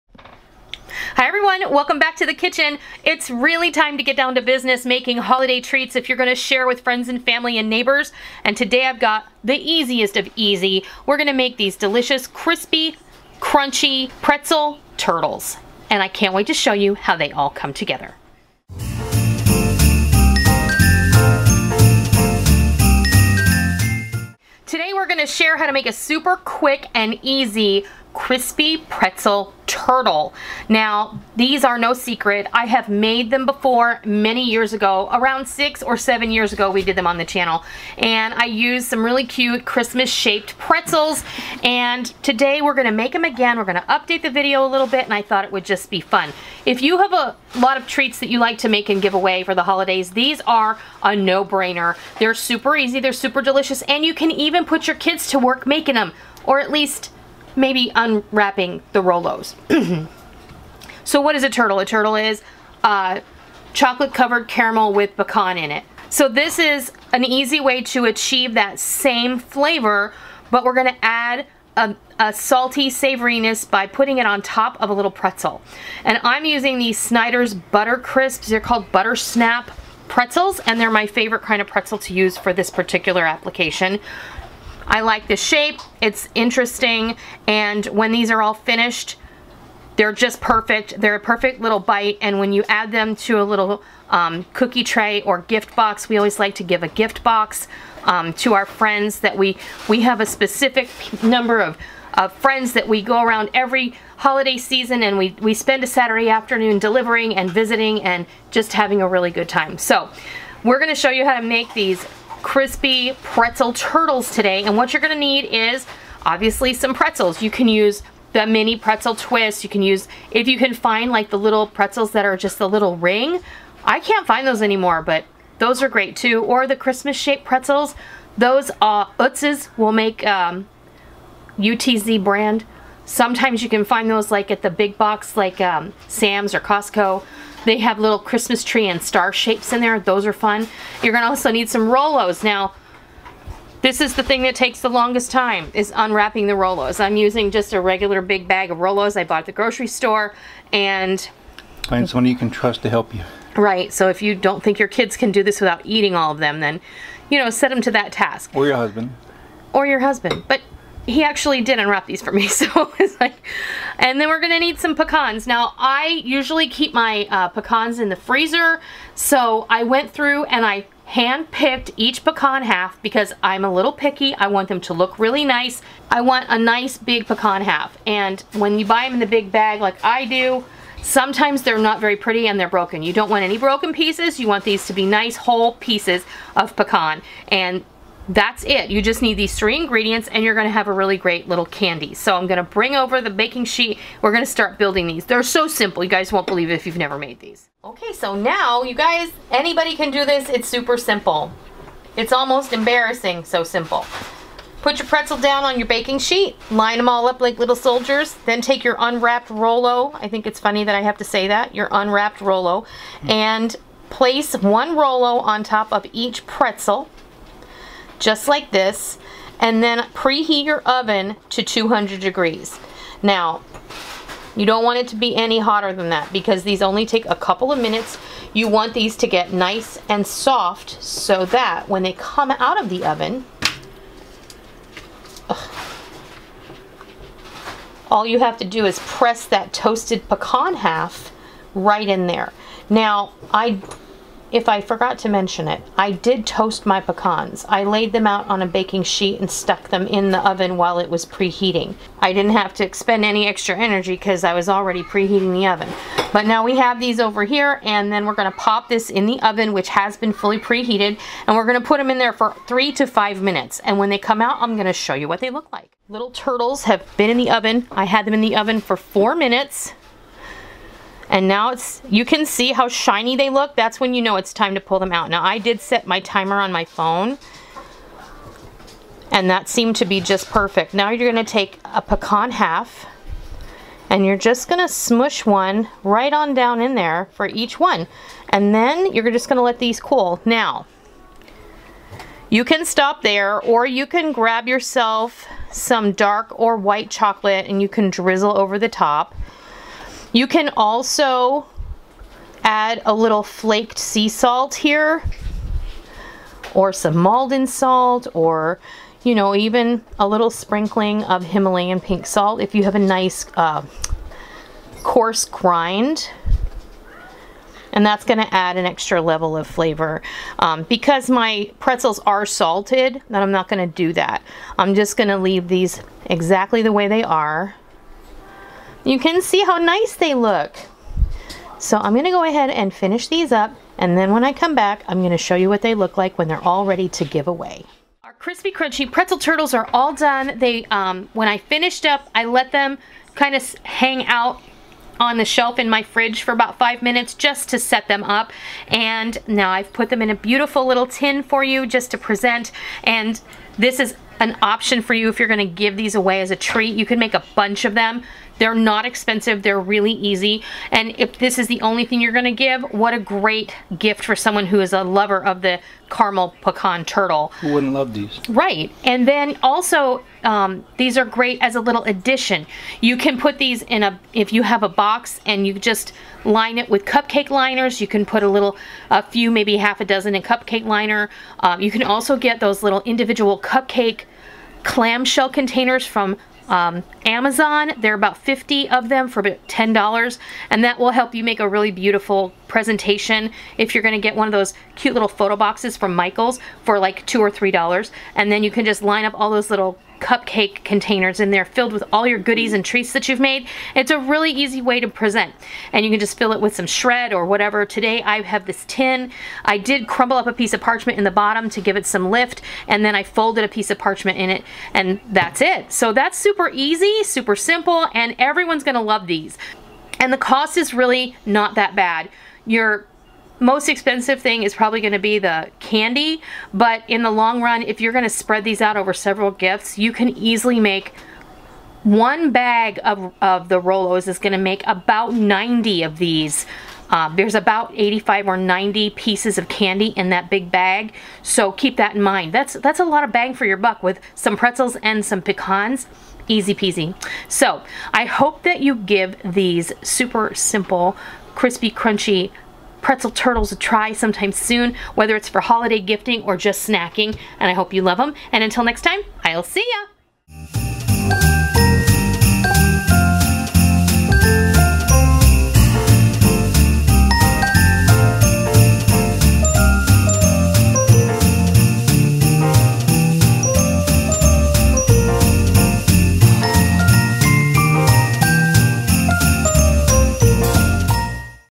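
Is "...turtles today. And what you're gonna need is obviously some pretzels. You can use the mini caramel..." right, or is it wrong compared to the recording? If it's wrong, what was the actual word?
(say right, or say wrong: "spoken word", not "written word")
wrong: "pretzel", not "caramel".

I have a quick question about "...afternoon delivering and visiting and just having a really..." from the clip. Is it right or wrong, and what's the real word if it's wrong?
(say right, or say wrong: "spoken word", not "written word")
right.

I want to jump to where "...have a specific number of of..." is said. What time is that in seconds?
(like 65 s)
100 s.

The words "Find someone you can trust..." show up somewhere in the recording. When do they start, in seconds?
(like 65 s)
151 s.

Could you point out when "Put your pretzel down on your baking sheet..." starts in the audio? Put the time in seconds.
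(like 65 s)
204 s.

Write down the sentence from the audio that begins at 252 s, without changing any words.
I didn't have to expend any extra energy because I was already preheating the oven.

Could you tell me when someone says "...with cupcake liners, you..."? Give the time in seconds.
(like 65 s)
376 s.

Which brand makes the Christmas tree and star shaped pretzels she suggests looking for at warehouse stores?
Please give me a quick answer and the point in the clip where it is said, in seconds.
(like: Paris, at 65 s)
UTZ, at 131 s.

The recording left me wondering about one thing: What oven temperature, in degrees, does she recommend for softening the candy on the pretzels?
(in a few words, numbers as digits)
200.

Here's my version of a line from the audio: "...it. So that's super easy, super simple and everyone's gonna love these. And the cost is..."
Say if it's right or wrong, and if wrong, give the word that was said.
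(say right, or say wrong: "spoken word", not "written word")
right.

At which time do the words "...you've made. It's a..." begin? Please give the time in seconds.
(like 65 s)
403 s.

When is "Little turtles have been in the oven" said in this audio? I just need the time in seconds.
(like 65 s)
266 s.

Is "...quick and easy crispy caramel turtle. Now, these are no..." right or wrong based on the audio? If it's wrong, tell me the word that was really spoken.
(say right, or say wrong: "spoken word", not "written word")
wrong: "pretzel", not "caramel".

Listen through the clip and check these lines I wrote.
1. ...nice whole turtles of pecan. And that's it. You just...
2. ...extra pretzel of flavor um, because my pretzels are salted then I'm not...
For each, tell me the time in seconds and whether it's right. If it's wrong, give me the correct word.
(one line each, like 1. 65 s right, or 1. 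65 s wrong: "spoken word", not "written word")
1. 185 s wrong: "pieces", not "turtles"
2. 318 s wrong: "level", not "pretzel".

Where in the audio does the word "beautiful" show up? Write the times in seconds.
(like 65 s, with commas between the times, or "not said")
350 s, 391 s.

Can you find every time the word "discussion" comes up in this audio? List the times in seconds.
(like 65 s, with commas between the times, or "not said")
not said.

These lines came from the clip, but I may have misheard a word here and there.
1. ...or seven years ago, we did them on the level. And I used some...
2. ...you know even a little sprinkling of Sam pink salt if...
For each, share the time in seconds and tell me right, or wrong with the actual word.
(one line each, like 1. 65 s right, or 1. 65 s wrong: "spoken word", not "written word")
1. 35 s wrong: "channel", not "level"
2. 309 s wrong: "Himalayan", not "Sam".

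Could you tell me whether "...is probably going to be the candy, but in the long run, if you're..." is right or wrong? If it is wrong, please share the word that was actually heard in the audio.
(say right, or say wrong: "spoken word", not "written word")
right.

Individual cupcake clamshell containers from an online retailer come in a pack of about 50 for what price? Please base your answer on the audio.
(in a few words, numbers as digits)
$10.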